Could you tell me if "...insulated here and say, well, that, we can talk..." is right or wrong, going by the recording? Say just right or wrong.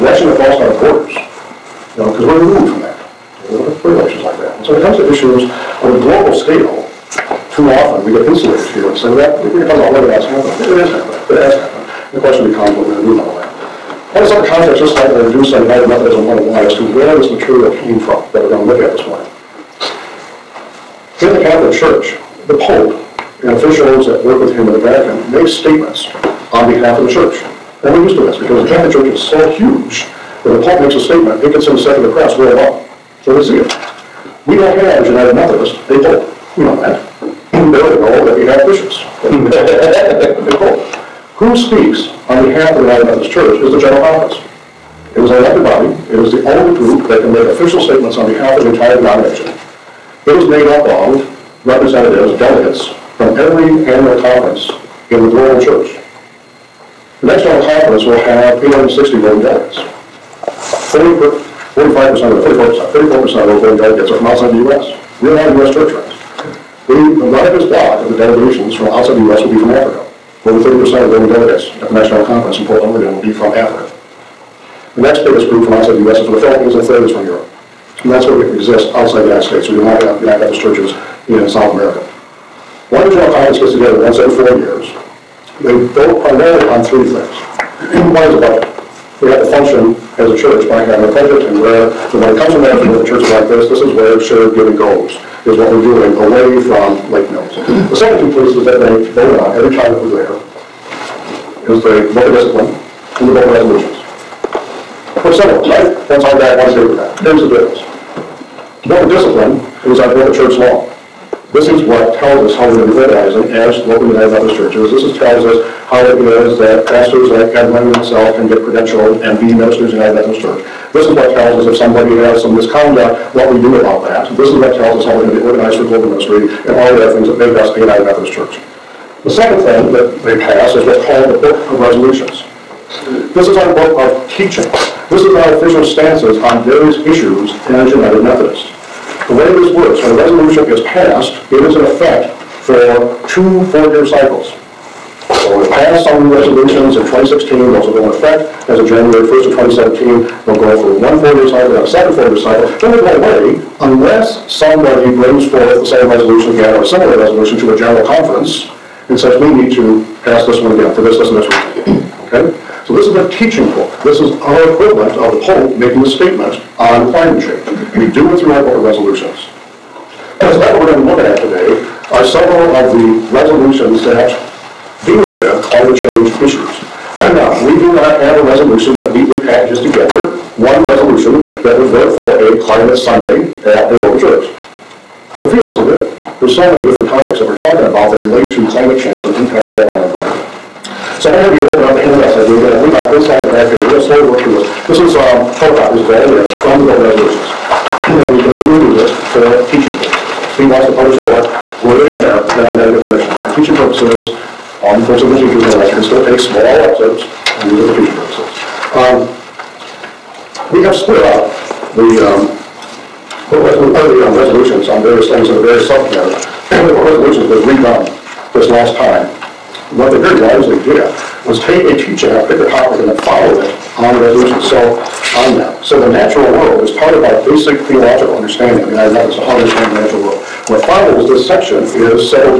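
right.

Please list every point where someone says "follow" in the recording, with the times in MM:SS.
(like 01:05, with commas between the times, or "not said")
03:43, 03:50.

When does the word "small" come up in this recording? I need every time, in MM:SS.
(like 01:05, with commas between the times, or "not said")
03:26.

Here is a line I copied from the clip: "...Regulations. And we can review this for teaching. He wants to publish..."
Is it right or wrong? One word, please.
right.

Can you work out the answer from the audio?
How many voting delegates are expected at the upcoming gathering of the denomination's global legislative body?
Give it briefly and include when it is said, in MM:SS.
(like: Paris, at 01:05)
860, at 00:58.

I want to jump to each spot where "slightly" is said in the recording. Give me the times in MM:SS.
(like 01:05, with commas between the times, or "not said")
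00:14.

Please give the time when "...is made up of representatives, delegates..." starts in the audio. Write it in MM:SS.
00:50.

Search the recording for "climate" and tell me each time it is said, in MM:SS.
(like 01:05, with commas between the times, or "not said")
02:47, 02:55, 03:02, 03:08.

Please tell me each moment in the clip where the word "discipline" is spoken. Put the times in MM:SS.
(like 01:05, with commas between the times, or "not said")
01:42, 01:49.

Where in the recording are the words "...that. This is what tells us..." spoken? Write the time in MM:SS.
02:04.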